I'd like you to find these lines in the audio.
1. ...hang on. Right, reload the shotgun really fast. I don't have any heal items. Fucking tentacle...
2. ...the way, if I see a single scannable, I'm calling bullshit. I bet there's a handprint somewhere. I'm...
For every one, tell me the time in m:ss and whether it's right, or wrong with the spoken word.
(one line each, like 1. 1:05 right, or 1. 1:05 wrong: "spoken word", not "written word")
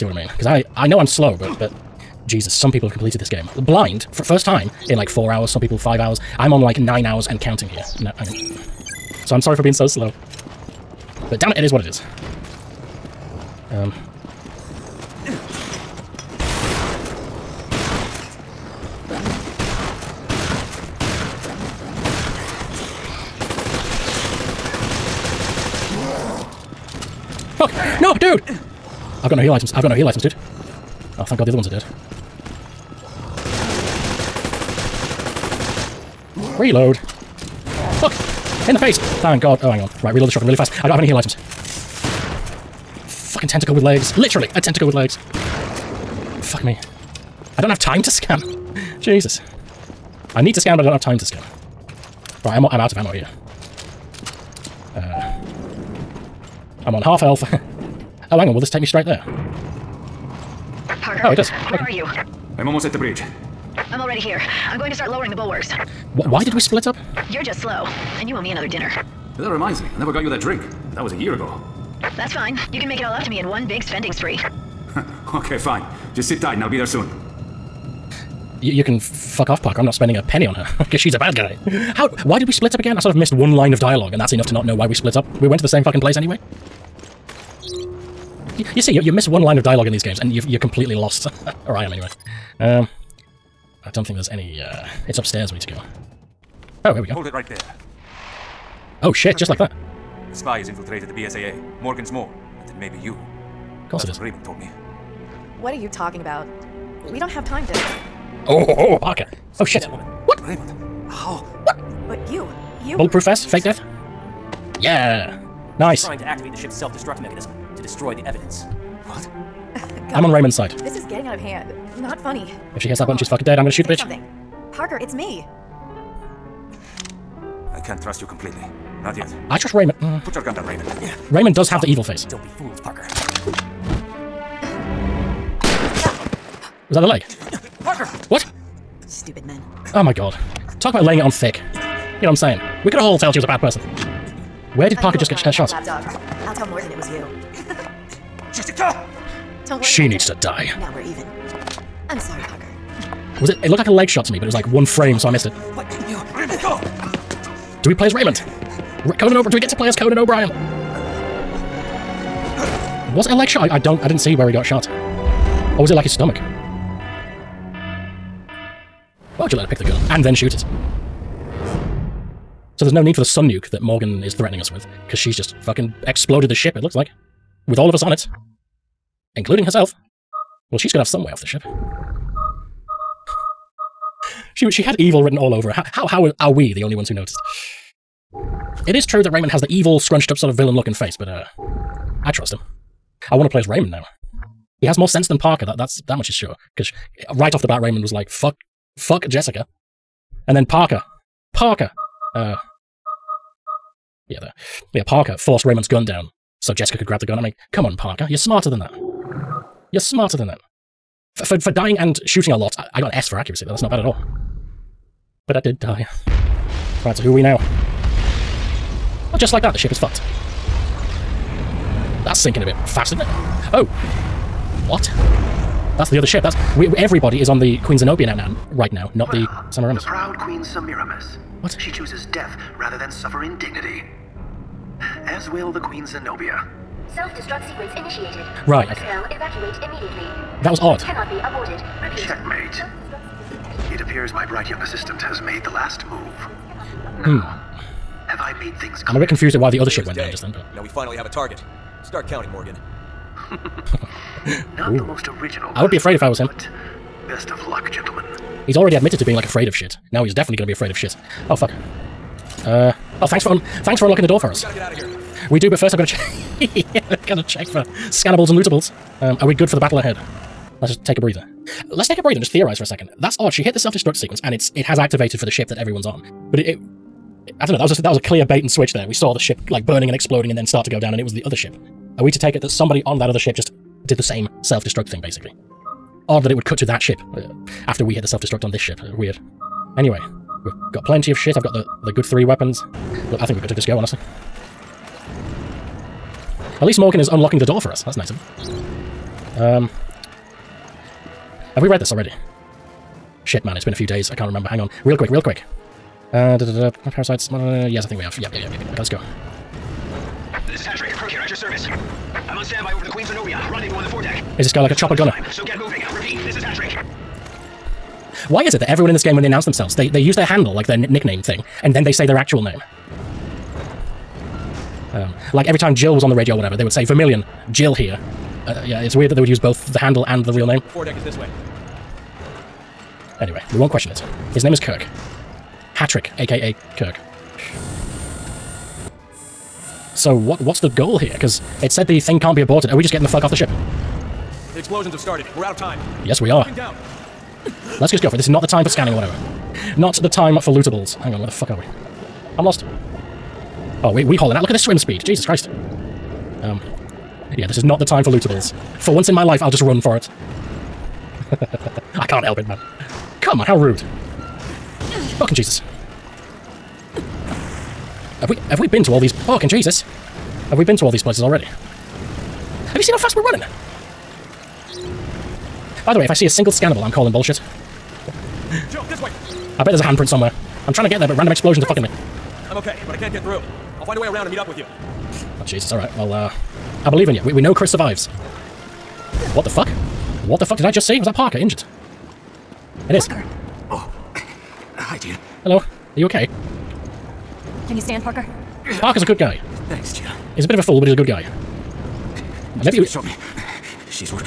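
1. 0:39 right
2. 6:16 right.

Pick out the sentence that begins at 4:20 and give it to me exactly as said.
Now he's definitely going to be afraid of shit.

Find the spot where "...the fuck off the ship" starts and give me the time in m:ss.
5:43.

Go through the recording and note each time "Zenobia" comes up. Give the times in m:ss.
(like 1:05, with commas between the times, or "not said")
3:47, 3:56, 5:13.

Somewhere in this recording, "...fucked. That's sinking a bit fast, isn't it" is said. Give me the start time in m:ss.
3:39.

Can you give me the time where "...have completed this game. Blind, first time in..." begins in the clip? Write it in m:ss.
0:02.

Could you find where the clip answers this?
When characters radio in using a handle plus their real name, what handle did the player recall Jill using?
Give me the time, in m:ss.
5:27.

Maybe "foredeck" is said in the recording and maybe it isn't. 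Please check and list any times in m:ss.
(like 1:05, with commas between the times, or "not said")
5:14, 5:30.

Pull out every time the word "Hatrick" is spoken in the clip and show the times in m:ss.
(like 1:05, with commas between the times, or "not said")
5:10.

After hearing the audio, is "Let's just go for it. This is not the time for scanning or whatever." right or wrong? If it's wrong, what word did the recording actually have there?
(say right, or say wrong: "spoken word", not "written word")
right.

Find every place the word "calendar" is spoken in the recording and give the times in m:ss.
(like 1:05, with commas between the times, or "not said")
not said.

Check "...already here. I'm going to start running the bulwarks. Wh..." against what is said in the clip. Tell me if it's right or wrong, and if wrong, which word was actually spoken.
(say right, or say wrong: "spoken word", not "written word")
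wrong: "lowering", not "running".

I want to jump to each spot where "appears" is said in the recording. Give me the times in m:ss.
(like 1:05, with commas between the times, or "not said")
4:03.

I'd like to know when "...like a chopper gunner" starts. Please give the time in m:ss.
5:14.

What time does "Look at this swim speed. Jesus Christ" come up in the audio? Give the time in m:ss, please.
5:54.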